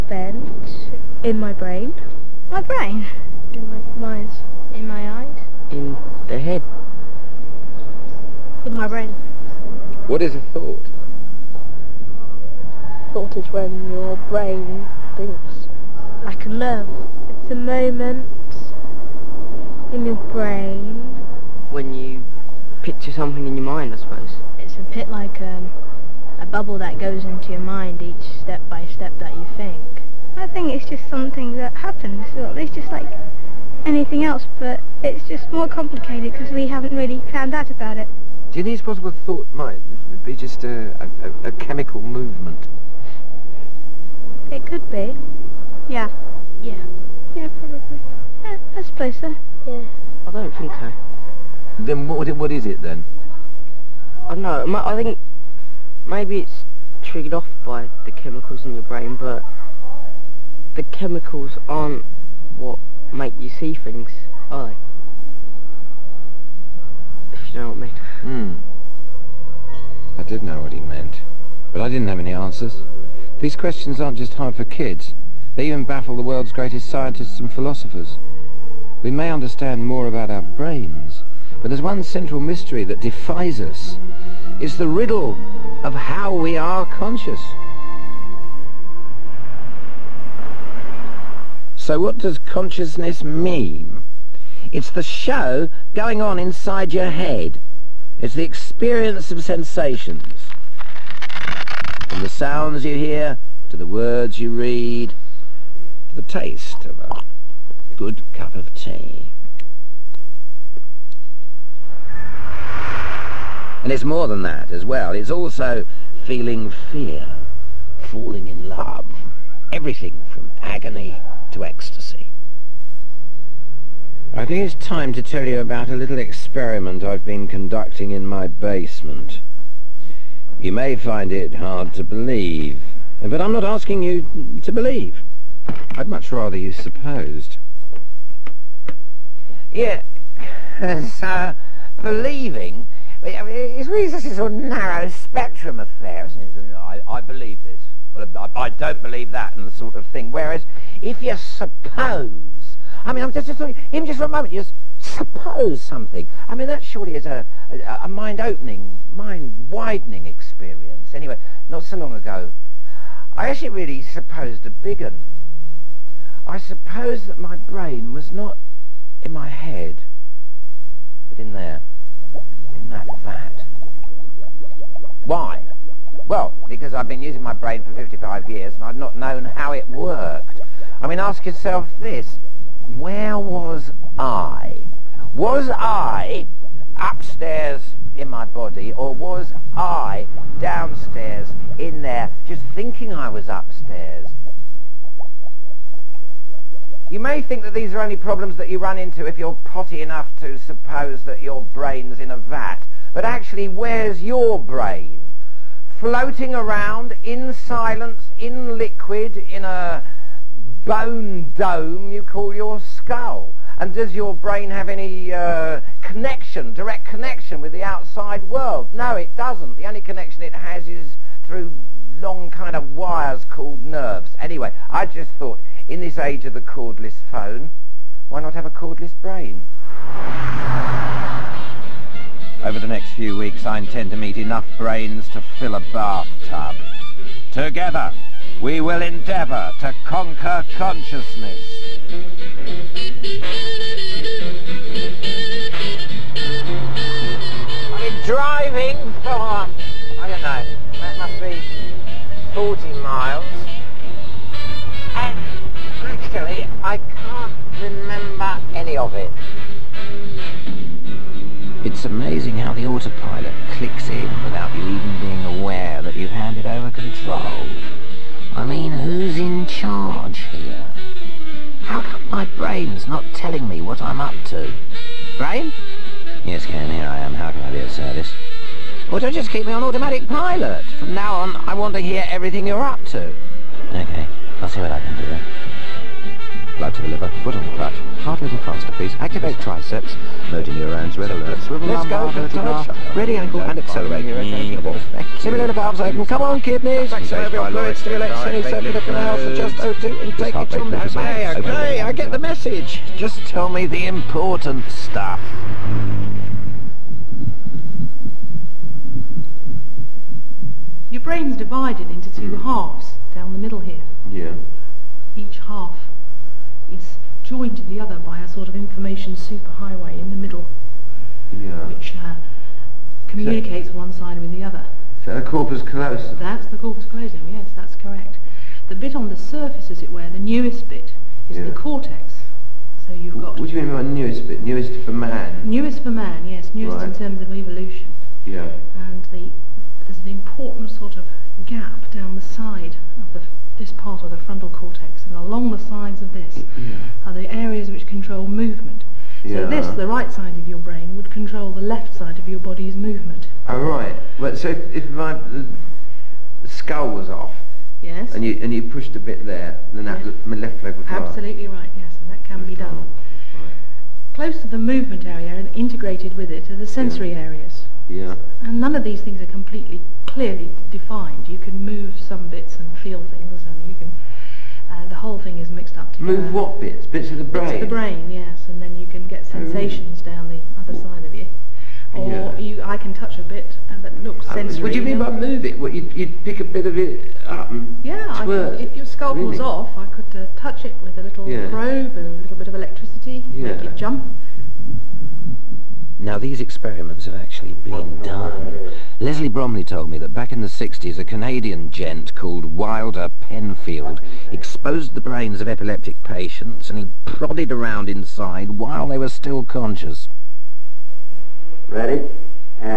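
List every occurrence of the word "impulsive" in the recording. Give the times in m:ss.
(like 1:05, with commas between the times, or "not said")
not said.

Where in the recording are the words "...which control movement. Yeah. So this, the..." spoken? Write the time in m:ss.
5:47.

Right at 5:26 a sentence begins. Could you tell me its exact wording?
That's the corpus callosum, yes, that's correct.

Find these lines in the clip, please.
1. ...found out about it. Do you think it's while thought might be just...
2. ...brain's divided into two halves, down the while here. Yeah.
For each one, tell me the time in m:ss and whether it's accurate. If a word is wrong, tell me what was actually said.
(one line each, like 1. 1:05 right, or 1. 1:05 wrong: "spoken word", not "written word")
1. 0:37 wrong: "possible", not "while"
2. 5:11 wrong: "middle", not "while".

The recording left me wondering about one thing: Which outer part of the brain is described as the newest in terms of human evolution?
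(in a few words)
The cortex.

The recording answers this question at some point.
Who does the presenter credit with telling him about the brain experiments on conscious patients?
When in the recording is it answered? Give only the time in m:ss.
6:39.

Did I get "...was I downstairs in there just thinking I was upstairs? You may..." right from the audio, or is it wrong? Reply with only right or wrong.
right.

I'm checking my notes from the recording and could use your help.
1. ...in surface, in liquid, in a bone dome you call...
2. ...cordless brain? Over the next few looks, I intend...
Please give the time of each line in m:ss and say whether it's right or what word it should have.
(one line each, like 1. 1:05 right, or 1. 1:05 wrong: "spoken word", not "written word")
1. 3:27 wrong: "silence", not "surface"
2. 3:48 wrong: "weeks", not "looks".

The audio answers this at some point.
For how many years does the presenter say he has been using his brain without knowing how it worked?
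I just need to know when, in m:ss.
2:57.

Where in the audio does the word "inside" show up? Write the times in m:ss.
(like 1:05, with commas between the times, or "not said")
1:36, 6:48.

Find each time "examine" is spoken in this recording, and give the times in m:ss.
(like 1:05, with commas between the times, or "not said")
not said.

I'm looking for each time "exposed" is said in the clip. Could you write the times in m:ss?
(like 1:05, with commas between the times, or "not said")
6:44.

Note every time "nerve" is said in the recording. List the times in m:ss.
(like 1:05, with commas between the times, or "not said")
0:16, 3:43.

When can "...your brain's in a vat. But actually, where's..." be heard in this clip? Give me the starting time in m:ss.
3:21.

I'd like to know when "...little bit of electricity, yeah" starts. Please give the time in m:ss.
6:32.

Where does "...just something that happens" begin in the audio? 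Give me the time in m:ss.
0:30.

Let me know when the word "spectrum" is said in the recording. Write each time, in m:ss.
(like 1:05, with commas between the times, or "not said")
2:25.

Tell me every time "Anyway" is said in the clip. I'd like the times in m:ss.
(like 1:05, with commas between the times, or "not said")
2:41, 3:44.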